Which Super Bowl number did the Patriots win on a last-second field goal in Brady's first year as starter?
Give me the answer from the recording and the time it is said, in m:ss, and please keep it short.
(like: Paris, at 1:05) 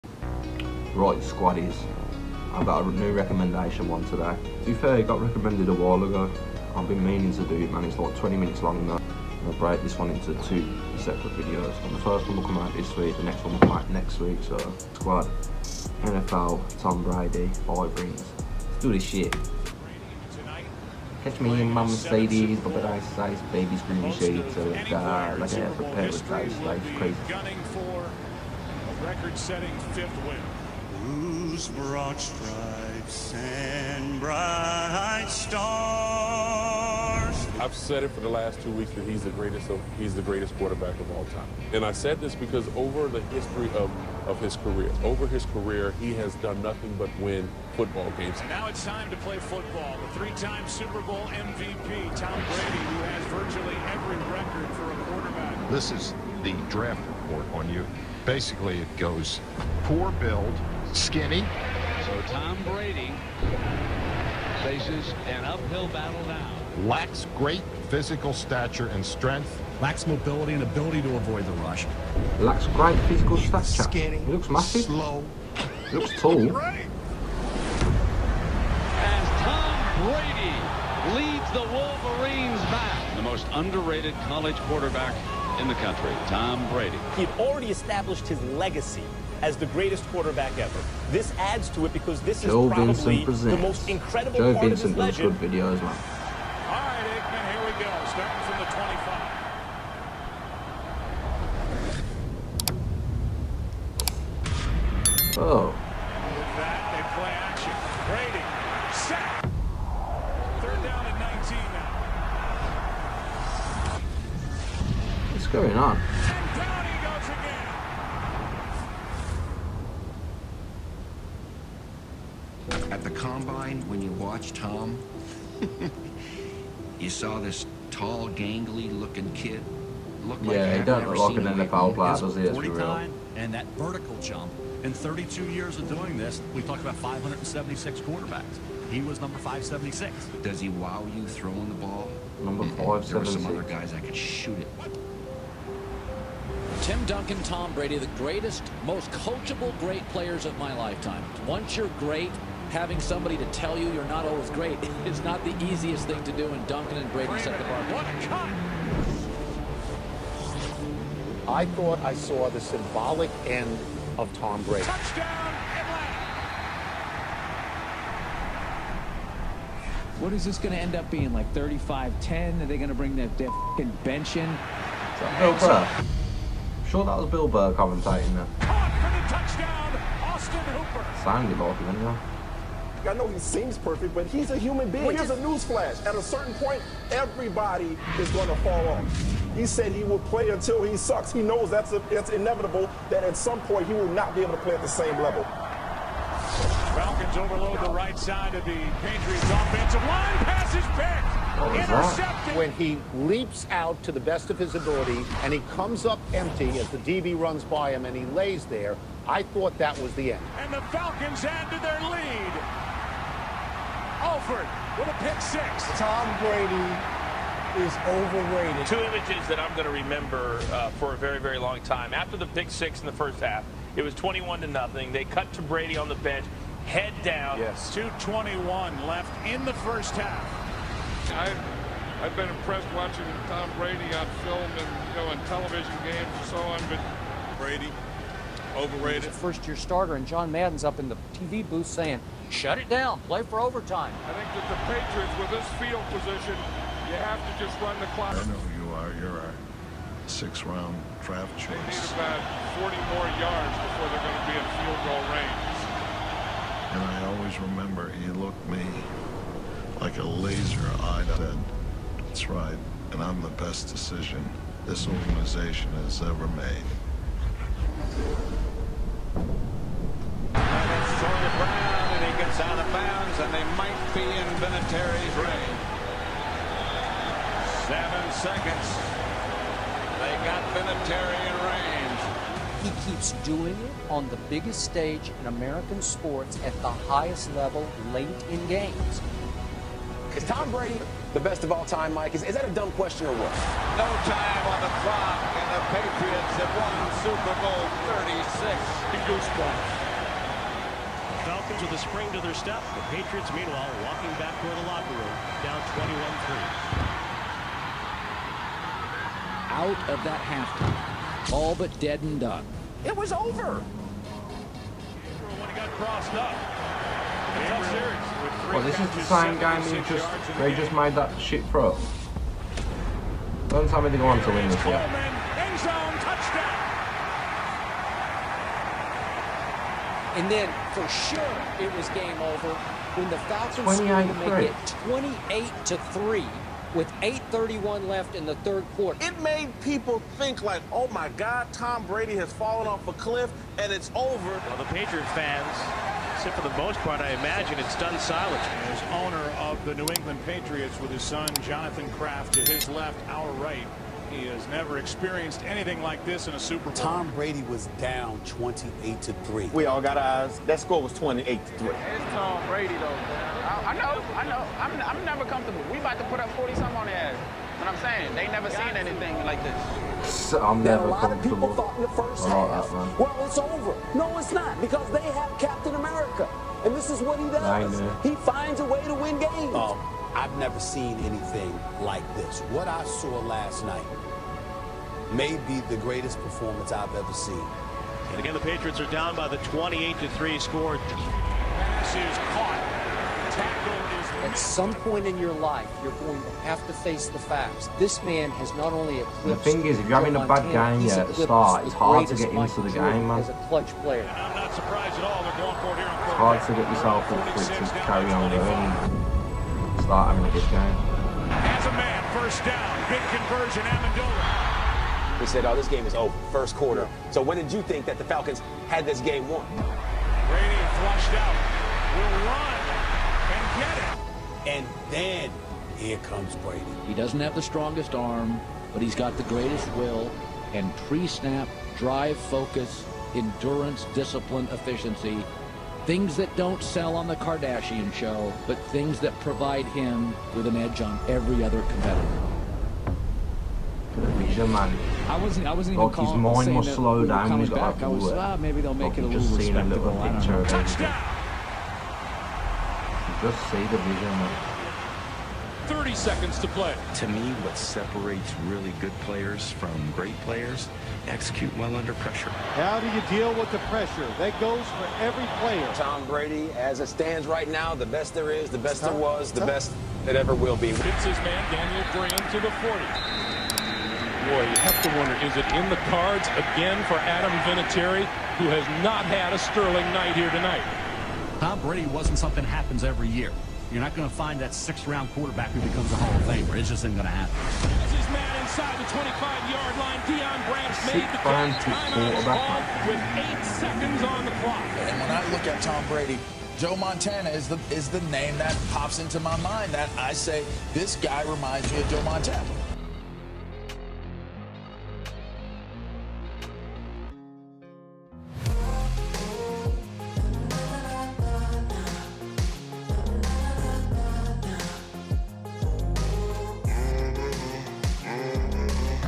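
Super Bowl 36, at 4:57.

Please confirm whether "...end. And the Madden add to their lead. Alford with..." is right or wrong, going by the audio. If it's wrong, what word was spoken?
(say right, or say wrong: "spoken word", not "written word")
wrong: "Falcons", not "Madden".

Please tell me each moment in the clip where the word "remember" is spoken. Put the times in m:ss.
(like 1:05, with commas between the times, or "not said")
3:40, 4:17.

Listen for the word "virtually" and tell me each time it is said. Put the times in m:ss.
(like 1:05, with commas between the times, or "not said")
0:53.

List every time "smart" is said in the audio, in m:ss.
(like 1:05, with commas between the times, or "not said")
not said.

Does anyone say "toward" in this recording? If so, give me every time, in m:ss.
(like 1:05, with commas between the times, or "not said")
5:04.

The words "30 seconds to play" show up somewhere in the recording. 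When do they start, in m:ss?
7:35.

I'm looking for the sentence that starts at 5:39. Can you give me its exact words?
It made people think like, oh my God, Tom Brady has fallen off a cliff and it's over.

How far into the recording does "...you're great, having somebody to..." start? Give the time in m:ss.
2:31.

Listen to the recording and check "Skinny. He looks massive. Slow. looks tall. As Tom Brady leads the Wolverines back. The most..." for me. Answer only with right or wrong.
right.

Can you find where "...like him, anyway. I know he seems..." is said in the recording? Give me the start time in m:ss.
3:01.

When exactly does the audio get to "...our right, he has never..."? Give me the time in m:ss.
5:53.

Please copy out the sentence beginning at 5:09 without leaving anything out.
Out of that halftime, all but dead and done.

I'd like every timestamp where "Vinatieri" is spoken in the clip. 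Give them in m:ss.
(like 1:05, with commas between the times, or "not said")
4:34, 4:40, 7:57.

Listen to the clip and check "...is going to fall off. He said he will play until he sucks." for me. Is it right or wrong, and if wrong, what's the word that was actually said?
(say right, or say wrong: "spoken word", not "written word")
right.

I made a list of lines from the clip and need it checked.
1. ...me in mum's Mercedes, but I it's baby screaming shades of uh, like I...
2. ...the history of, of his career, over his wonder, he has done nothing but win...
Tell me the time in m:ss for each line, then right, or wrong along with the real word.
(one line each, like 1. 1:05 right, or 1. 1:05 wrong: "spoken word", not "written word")
1. 0:21 right
2. 0:43 wrong: "career", not "wonder".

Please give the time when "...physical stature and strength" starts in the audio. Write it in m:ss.
1:07.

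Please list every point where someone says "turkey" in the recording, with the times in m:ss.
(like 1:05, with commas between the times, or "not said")
not said.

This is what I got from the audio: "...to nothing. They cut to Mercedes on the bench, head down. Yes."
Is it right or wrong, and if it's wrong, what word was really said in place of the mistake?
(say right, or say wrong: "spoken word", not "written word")
wrong: "Brady", not "Mercedes".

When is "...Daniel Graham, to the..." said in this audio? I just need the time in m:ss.
7:51.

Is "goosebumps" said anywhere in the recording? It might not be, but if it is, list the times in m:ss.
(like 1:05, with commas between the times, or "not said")
4:59.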